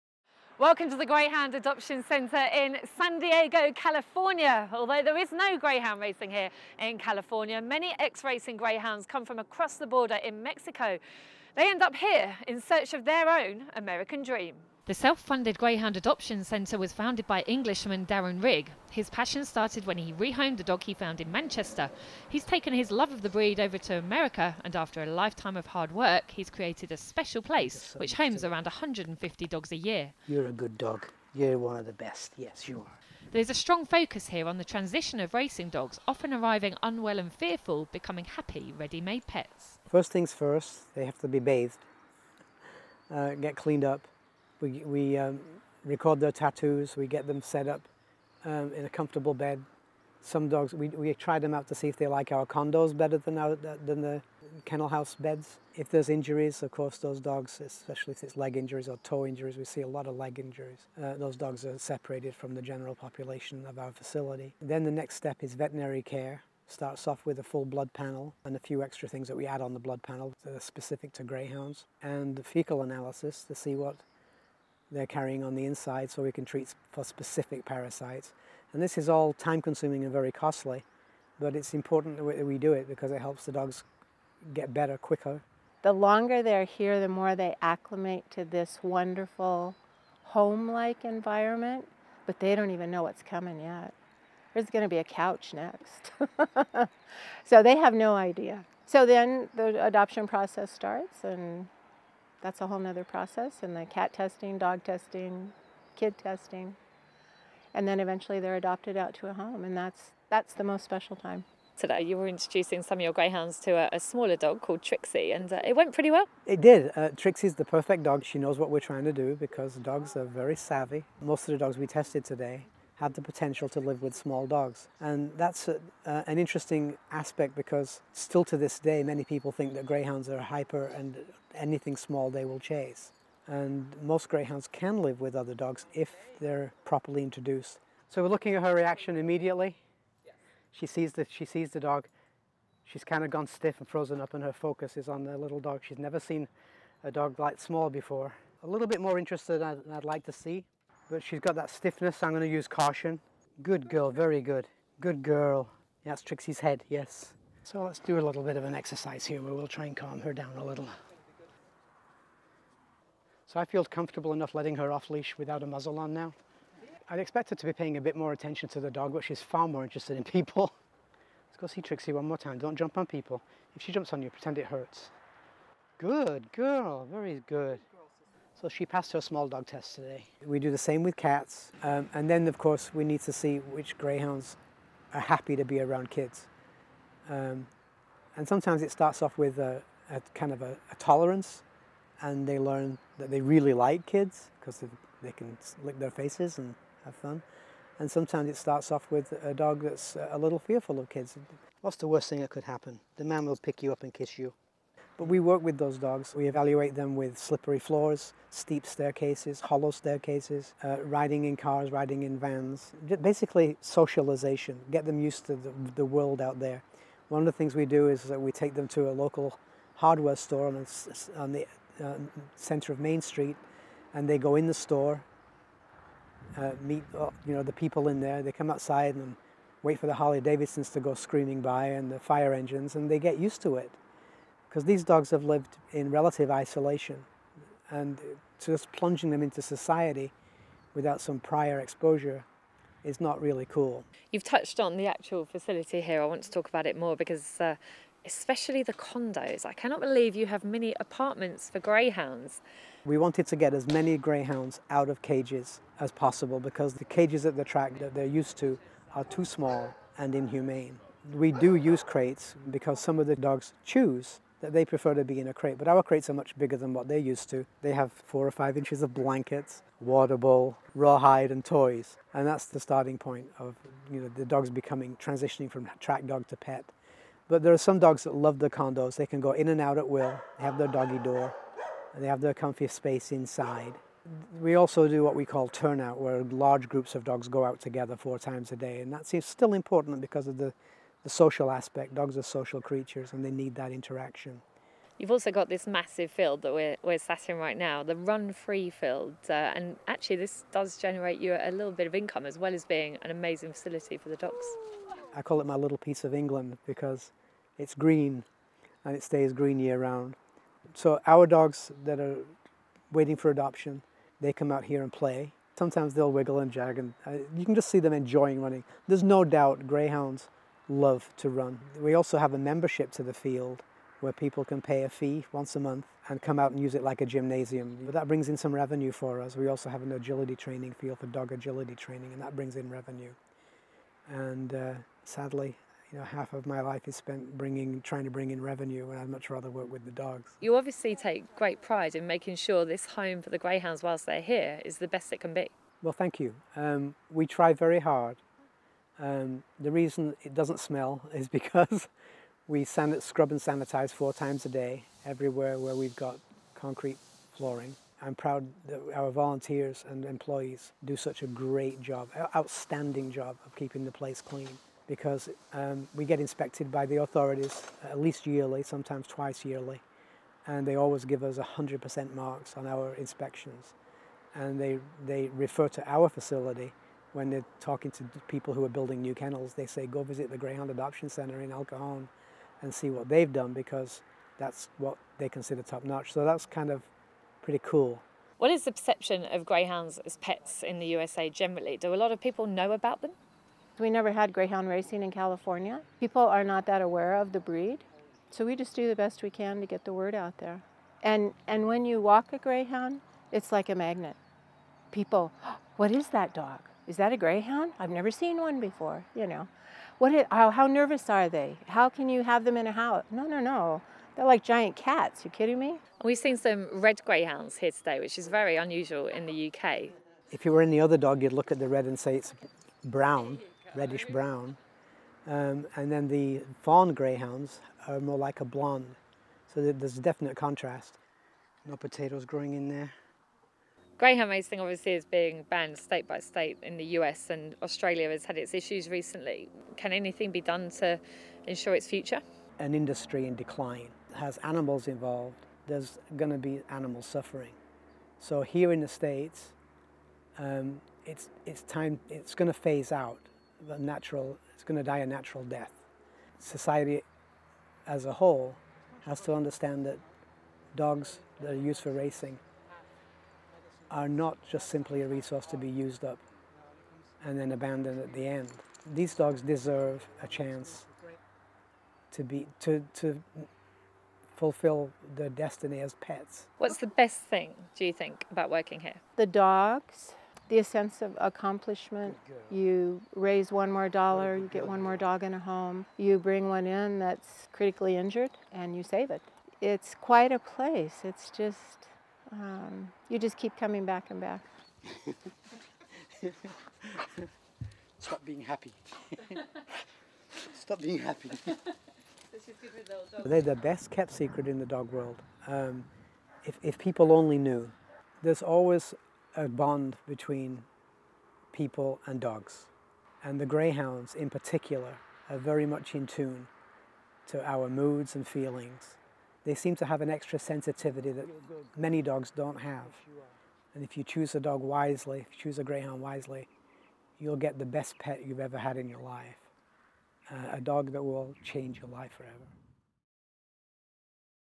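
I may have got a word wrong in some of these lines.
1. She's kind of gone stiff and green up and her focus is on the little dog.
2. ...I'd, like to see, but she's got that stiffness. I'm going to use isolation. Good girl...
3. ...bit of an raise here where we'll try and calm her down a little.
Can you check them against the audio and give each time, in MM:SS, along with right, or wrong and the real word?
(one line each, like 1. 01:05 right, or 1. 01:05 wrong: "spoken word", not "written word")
1. 02:22 wrong: "frozen", not "green"
2. 02:29 wrong: "caution", not "isolation"
3. 02:38 wrong: "exercise", not "raise".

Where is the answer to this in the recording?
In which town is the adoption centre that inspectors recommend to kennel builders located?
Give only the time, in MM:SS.
06:21.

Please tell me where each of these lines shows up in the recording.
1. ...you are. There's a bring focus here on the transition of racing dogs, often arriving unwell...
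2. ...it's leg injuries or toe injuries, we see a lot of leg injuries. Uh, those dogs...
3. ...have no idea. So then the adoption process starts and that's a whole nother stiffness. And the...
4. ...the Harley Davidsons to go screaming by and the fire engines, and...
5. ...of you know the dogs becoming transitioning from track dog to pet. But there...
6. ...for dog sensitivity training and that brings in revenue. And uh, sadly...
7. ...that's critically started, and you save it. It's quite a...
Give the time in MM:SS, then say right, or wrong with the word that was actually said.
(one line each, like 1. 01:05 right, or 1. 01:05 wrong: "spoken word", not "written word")
1. 00:32 wrong: "strong", not "bring"
2. 00:58 right
3. 01:37 wrong: "process", not "stiffness"
4. 03:50 right
5. 04:33 right
6. 05:31 wrong: "agility", not "sensitivity"
7. 08:07 wrong: "injured", not "started".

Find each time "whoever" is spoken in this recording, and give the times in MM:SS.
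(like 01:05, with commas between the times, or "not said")
not said.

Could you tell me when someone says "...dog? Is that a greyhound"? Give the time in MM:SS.
06:46.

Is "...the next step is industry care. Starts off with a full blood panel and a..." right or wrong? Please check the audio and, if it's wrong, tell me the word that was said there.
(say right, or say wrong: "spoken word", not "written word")
wrong: "veterinary", not "industry".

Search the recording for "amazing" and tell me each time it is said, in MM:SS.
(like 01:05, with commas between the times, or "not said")
05:03.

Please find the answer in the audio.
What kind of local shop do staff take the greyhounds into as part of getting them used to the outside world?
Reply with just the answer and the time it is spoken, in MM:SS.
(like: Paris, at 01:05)
Hardware store, at 03:39.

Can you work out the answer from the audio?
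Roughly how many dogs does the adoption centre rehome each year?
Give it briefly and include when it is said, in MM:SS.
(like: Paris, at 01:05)
150, at 00:28.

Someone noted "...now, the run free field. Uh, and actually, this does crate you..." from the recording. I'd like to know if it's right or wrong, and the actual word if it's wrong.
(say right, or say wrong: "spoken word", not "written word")
wrong: "generate", not "crate".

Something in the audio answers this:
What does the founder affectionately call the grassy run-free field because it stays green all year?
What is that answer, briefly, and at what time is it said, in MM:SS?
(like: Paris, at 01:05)
My little piece of England, at 05:05.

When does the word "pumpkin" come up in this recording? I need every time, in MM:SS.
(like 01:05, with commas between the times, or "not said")
not said.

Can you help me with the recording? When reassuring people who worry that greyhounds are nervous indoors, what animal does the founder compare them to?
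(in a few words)
Giant cats.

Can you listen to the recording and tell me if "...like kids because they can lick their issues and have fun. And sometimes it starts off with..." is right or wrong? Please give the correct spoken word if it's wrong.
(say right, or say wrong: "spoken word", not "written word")
wrong: "faces", not "issues".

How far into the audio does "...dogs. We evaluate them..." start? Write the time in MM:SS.
03:25.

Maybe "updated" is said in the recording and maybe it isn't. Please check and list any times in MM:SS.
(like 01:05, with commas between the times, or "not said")
not said.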